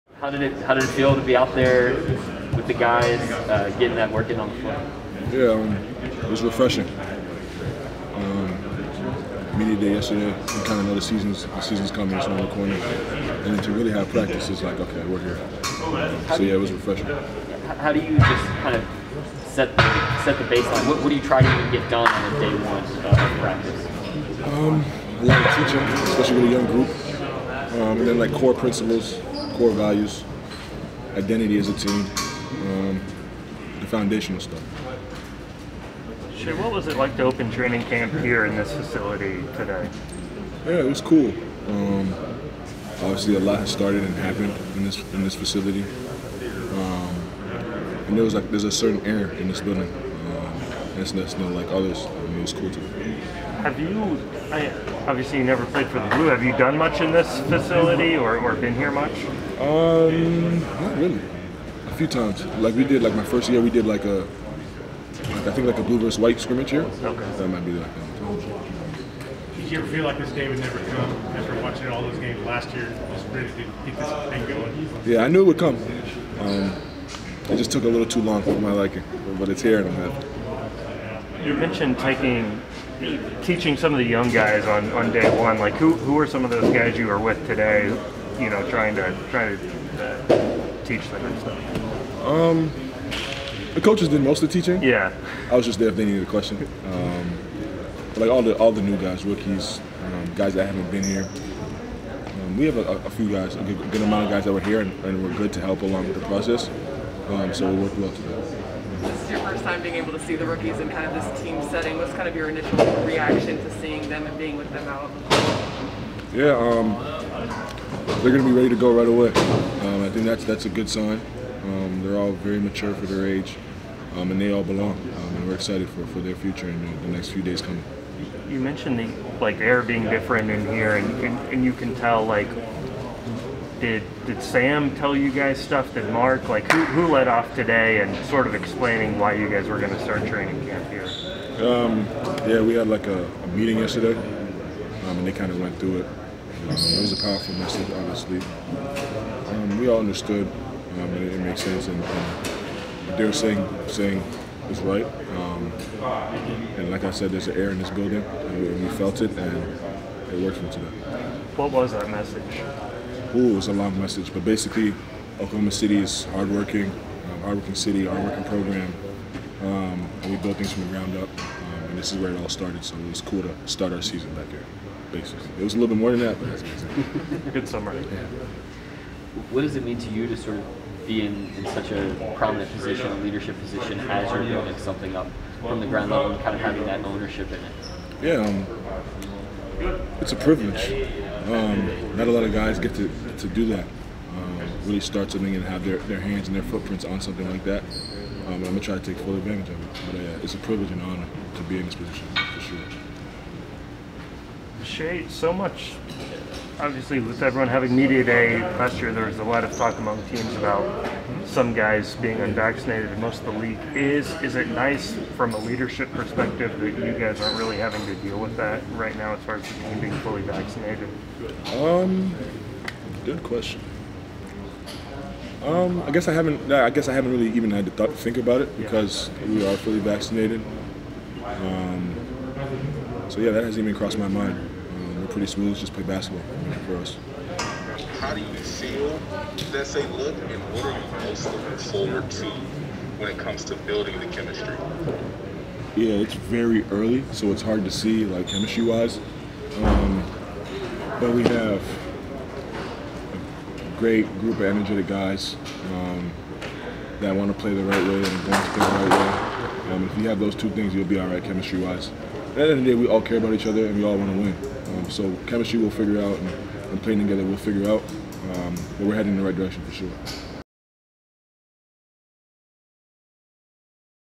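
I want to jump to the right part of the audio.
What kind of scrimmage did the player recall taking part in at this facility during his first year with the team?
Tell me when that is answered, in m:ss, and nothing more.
1:05.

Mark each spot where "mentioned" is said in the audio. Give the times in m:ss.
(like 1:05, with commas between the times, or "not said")
1:21, 2:08.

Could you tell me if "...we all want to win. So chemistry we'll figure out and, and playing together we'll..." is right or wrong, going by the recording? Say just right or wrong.
right.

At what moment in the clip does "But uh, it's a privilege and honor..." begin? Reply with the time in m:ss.
3:20.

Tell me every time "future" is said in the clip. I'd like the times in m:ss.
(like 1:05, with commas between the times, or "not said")
2:06.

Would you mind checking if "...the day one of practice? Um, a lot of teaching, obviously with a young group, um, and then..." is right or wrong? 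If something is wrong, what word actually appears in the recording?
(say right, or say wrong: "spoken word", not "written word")
wrong: "especially", not "obviously".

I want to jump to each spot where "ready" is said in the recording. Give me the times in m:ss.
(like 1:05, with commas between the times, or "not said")
1:13, 1:58.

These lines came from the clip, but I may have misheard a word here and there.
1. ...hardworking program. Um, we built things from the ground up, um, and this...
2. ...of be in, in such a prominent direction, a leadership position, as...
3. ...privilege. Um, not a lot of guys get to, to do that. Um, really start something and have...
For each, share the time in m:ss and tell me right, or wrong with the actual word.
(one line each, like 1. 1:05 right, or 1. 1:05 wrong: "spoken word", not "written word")
1. 2:48 right
2. 3:00 wrong: "position", not "direction"
3. 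3:10 right.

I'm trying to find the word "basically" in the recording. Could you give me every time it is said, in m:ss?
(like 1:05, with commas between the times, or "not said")
2:44, 2:55.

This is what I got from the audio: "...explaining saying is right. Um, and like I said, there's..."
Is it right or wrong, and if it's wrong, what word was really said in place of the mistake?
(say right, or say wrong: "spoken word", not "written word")
wrong: "saying", not "explaining".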